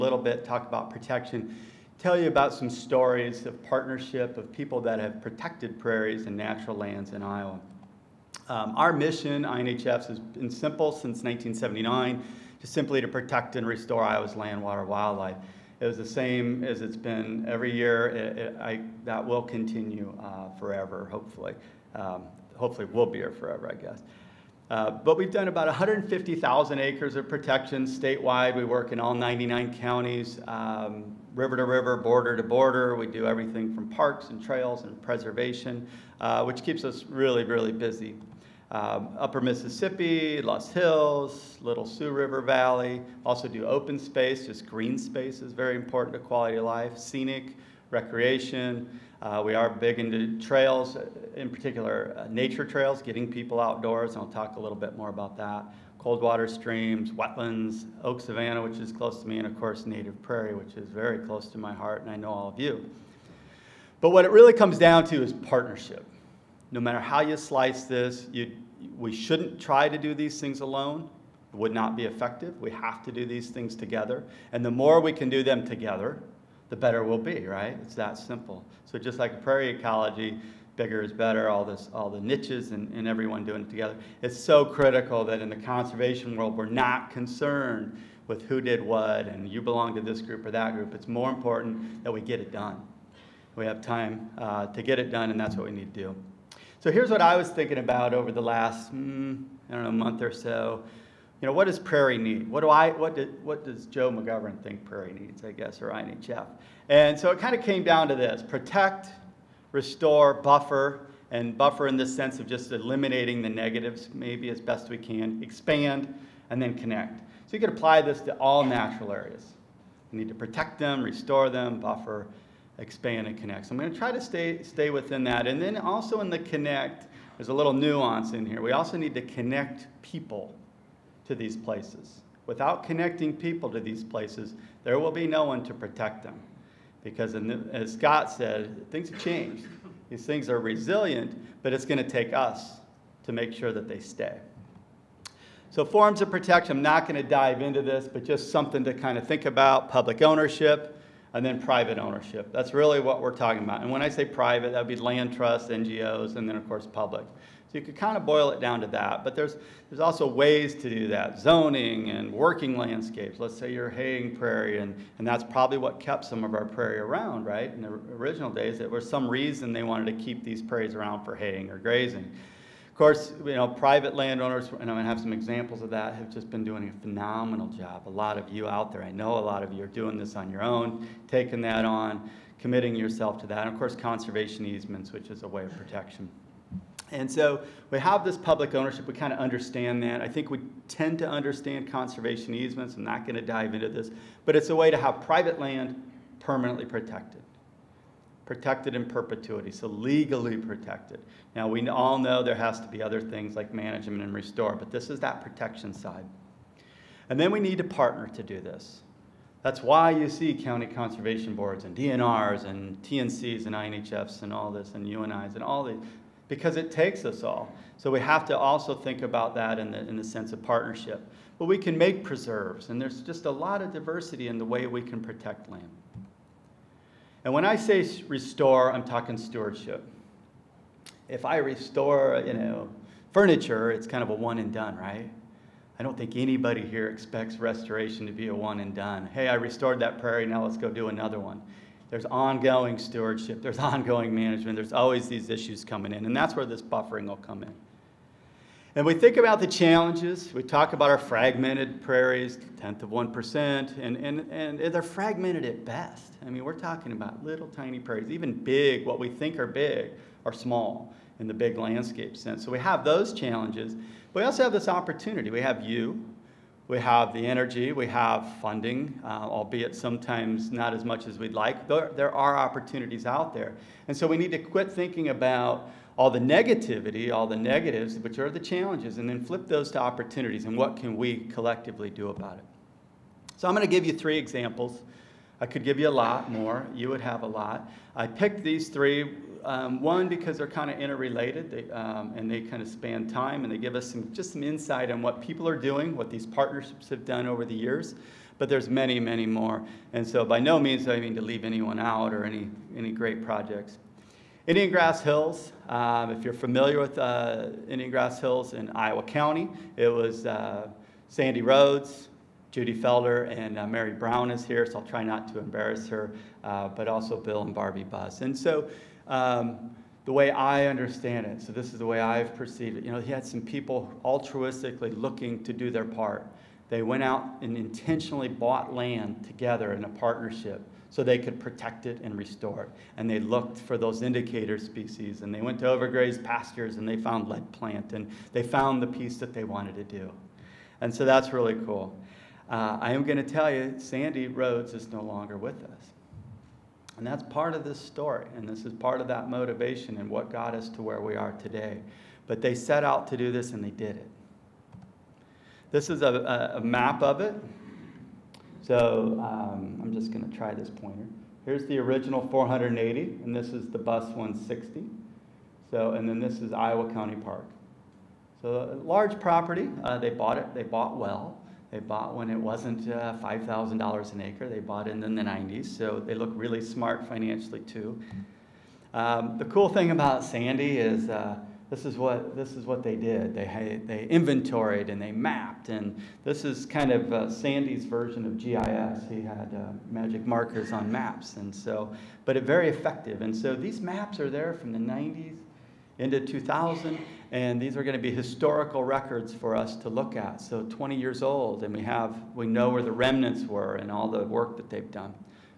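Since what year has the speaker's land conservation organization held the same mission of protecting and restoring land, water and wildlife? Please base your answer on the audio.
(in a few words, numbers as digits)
1979.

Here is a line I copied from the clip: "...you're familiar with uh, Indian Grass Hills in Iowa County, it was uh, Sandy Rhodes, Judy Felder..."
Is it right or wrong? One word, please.
right.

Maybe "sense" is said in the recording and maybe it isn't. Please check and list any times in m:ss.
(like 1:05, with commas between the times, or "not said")
1:52, 3:40, 4:22.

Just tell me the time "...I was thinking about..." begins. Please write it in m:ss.
1:37.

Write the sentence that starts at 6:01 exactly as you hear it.
Here's the original 480, and this is the Buss 160.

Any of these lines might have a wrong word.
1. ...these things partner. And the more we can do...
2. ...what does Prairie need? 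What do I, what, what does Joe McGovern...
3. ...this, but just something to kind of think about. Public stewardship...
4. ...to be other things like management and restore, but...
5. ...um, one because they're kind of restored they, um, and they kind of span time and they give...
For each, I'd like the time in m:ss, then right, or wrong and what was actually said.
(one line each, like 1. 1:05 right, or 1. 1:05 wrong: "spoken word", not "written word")
1. 1:13 wrong: "together", not "partner"
2. 1:41 right
3. 2:27 wrong: "ownership", not "stewardship"
4. 3:22 right
5. 4:49 wrong: "interrelated", not "restored".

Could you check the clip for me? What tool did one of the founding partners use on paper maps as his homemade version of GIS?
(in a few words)
Magic markers.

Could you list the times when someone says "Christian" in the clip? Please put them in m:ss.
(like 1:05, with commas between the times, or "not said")
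not said.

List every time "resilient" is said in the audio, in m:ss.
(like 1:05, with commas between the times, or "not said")
2:20.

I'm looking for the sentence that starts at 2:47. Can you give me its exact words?
In the original days, there was some reason they wanted to keep these prairies around for haying or grazing.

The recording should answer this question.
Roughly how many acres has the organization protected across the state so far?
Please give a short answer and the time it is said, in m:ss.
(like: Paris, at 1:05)
150,000, at 0:25.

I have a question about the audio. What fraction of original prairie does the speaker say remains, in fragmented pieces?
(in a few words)
a tenth of 1%.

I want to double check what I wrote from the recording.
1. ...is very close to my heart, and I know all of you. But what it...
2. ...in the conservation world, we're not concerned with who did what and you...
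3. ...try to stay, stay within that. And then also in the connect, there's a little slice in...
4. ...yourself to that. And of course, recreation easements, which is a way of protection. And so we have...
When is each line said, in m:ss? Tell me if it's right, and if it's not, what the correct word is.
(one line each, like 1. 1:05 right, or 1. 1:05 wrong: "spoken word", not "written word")
1. 1:00 right
2. 1:25 right
3. 2:03 wrong: "nuance", not "slice"
4. 3:02 wrong: "conservation", not "recreation".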